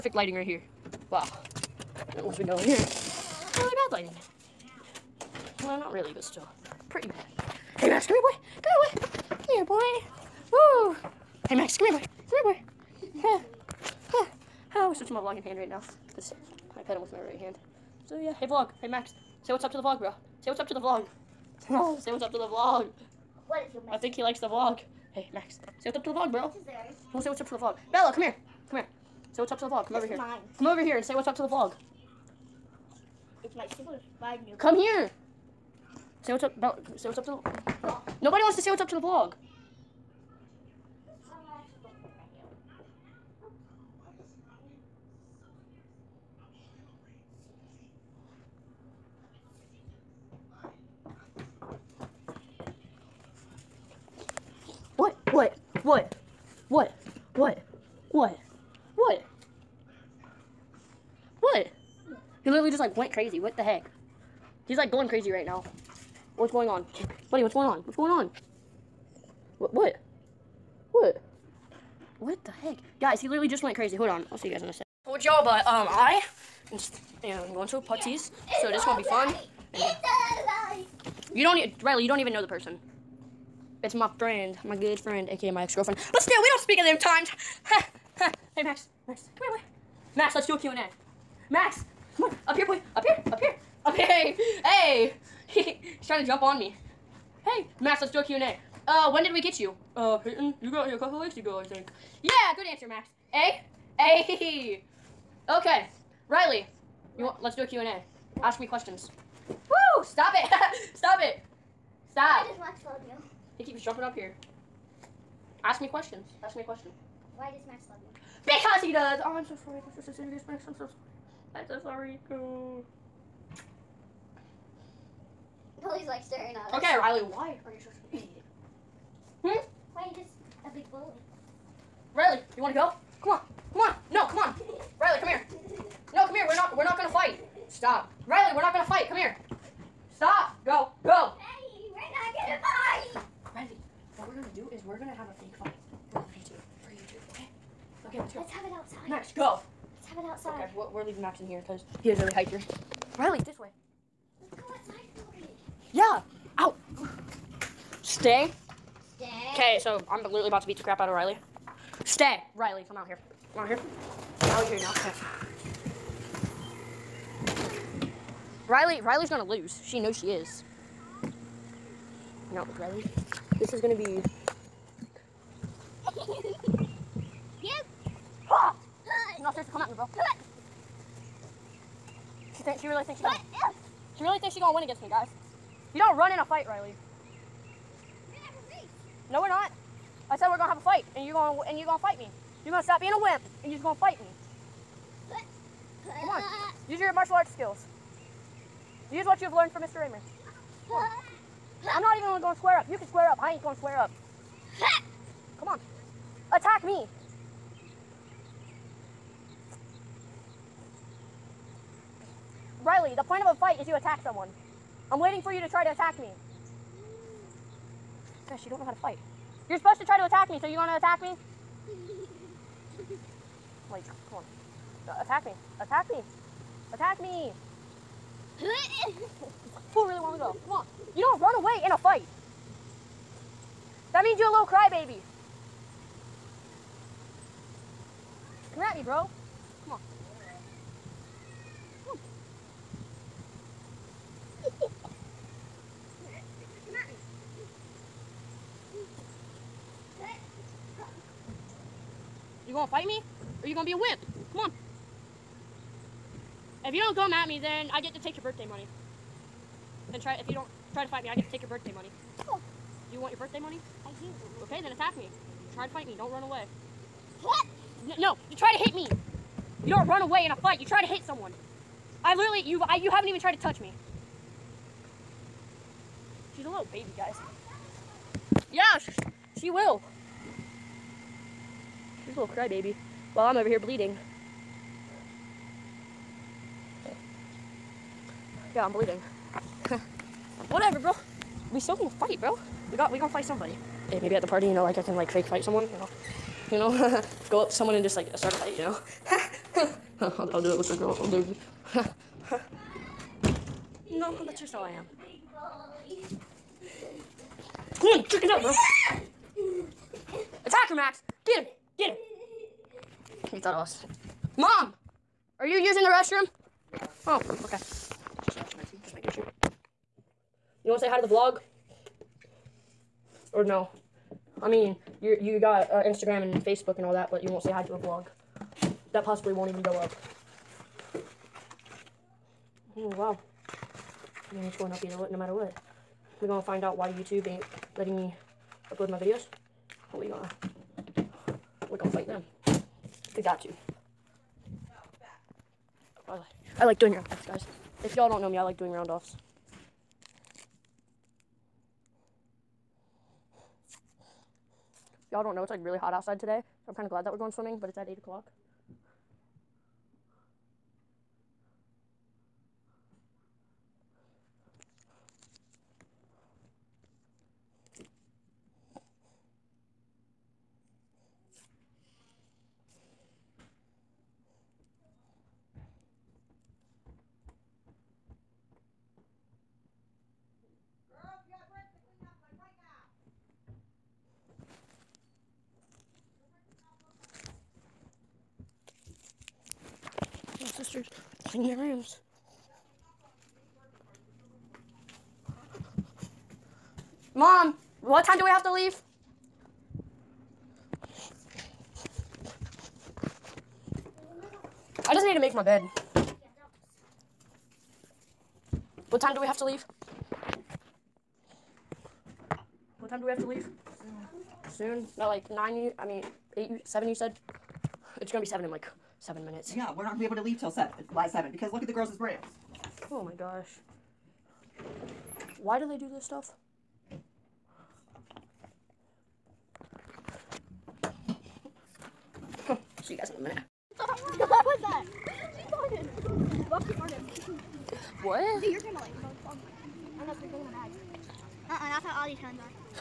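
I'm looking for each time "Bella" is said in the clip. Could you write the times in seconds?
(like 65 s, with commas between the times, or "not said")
27 s, 36 s.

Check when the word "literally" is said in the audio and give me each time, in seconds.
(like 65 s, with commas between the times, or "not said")
62 s, 73 s, 160 s, 272 s.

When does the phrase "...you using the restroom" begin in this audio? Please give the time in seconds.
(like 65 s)
315 s.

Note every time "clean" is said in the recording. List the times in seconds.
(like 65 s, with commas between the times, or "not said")
391 s.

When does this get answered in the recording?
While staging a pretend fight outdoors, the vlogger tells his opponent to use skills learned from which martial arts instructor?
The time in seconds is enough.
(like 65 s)
199 s.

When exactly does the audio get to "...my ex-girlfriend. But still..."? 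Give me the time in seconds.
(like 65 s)
85 s.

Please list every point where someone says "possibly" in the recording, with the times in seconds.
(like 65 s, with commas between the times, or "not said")
329 s.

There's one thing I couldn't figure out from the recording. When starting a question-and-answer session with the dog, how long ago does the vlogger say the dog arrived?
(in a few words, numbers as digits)
A couple weeks ago.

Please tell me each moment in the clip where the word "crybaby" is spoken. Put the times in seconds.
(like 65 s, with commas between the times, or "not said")
234 s, 282 s.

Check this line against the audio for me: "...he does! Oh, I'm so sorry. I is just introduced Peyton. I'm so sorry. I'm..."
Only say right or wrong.
wrong.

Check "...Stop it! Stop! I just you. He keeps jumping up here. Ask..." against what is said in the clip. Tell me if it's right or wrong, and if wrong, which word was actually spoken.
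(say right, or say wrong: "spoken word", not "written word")
right.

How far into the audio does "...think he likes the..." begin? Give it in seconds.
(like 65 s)
23 s.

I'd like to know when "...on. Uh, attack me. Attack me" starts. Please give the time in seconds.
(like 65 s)
224 s.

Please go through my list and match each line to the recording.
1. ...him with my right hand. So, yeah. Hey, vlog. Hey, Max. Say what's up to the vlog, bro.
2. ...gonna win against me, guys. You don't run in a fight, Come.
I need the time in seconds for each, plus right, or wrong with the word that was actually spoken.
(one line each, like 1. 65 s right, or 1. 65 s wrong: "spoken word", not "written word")
1. 16 s right
2. 184 s wrong: "Riley", not "Come".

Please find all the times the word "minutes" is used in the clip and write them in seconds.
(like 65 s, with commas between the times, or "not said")
419 s, 433 s.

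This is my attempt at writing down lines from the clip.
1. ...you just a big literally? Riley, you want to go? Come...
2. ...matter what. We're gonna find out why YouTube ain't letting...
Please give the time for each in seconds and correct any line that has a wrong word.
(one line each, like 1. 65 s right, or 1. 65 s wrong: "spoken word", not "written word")
1. 130 s wrong: "bully", not "literally"
2. 335 s right.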